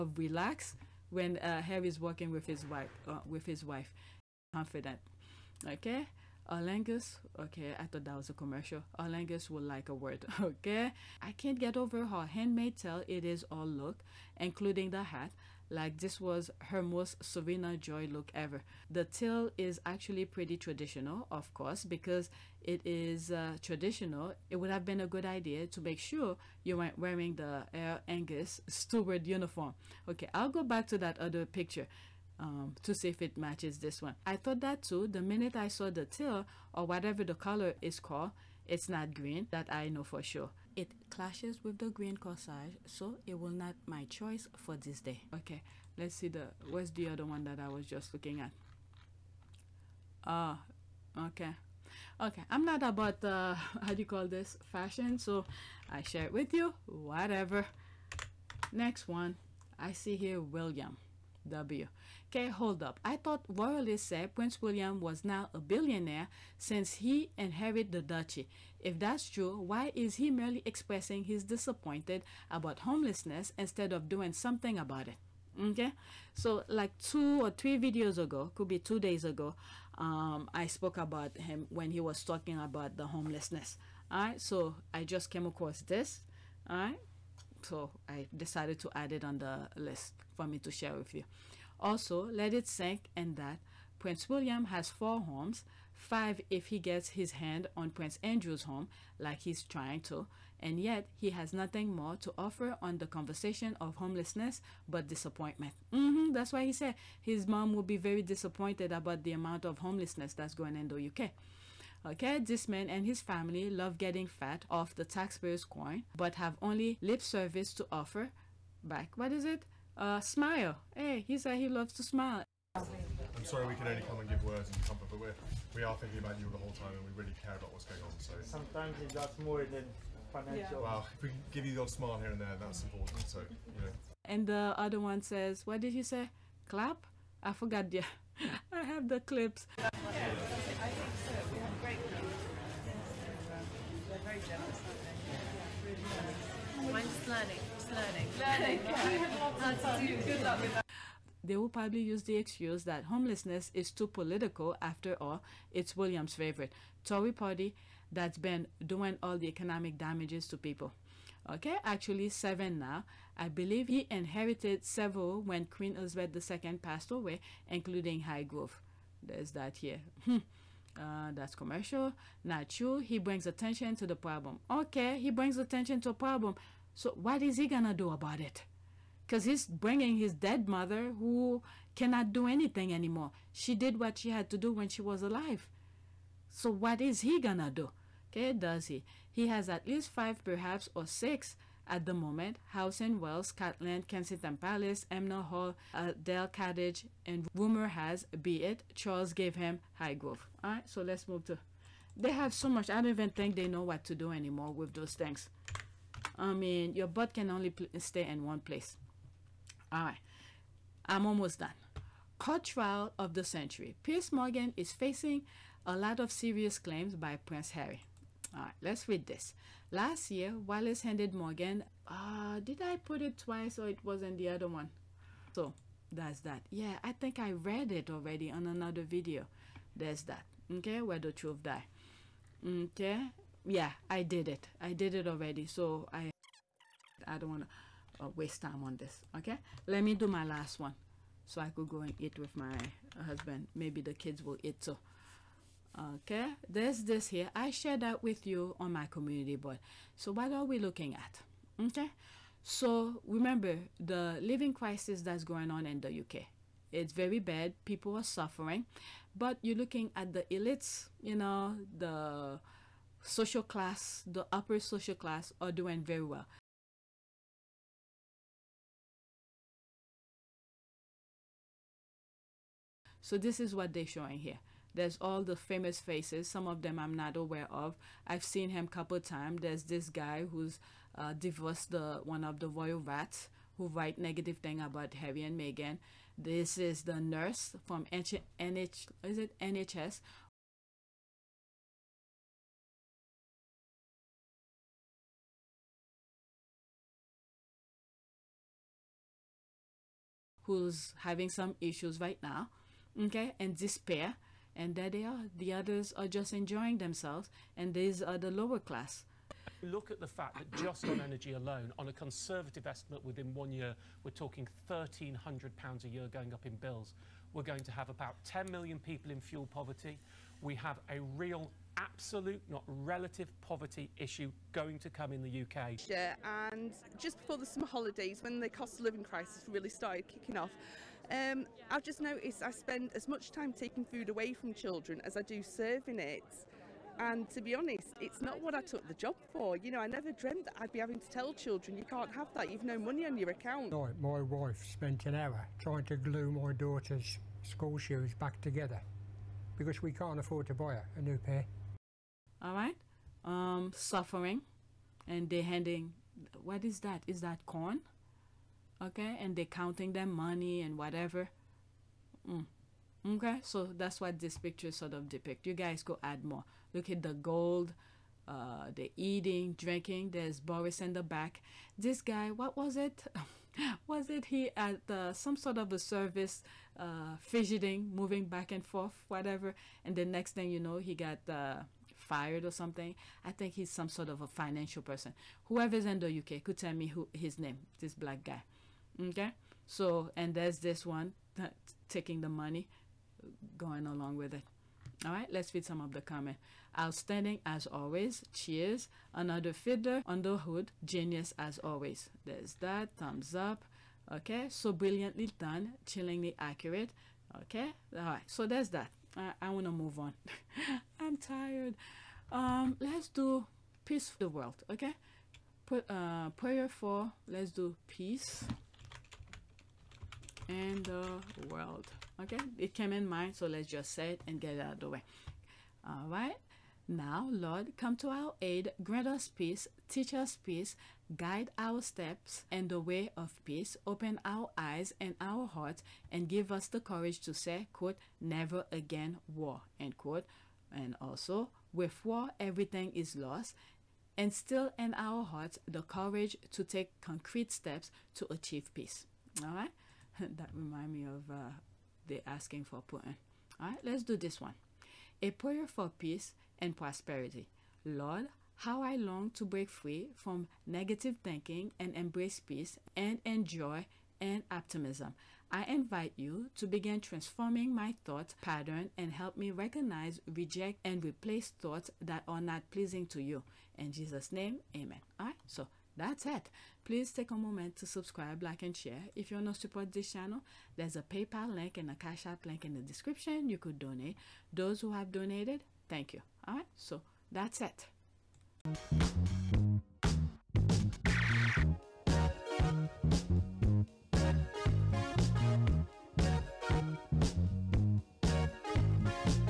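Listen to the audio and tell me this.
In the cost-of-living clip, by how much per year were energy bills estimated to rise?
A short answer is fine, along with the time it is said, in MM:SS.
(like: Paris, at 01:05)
£1,300, at 05:14.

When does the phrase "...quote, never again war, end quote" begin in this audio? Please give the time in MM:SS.
07:17.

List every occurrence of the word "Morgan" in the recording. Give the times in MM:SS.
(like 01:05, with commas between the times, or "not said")
03:34, 03:41.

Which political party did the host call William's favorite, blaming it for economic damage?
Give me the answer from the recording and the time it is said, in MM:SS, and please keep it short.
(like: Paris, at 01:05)
Tory, at 02:37.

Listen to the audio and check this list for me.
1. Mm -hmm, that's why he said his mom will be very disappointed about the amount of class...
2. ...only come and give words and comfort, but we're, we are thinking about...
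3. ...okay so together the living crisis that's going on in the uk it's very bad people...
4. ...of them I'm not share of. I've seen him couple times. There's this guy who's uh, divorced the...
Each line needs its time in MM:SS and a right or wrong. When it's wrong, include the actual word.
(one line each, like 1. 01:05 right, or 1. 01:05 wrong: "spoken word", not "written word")
1. 01:45 wrong: "homelessness", not "class"
2. 02:03 right
3. 04:11 wrong: "remember", not "together"
4. 04:36 wrong: "aware", not "share".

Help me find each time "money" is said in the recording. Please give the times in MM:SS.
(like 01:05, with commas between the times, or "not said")
05:42, 06:00, 06:32.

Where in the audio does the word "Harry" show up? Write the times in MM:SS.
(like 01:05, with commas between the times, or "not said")
00:01, 03:37, 04:45.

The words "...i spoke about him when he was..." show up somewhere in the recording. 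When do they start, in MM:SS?
01:20.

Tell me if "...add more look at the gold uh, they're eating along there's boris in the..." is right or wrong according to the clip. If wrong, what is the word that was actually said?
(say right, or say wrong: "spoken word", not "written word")
wrong: "drinking", not "along".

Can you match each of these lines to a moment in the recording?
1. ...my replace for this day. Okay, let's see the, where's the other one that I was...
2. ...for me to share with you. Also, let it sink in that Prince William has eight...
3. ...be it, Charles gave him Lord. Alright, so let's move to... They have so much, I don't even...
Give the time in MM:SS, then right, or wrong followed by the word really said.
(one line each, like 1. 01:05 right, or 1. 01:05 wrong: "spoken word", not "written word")
1. 00:43 wrong: "choice", not "replace"
2. 01:30 wrong: "four", not "eight"
3. 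03:18 wrong: "Highgrove", not "Lord".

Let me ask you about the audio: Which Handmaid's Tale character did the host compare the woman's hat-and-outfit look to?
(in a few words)
Serena Joy.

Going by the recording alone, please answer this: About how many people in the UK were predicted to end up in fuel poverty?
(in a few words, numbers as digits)
10 million.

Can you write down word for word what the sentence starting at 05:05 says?
The others are just enjoying themselves, and these are the lower class.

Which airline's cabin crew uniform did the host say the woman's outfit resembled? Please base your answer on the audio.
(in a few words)
Aer Lingus.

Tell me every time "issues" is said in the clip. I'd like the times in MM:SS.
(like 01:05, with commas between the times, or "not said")
05:01, 05:24.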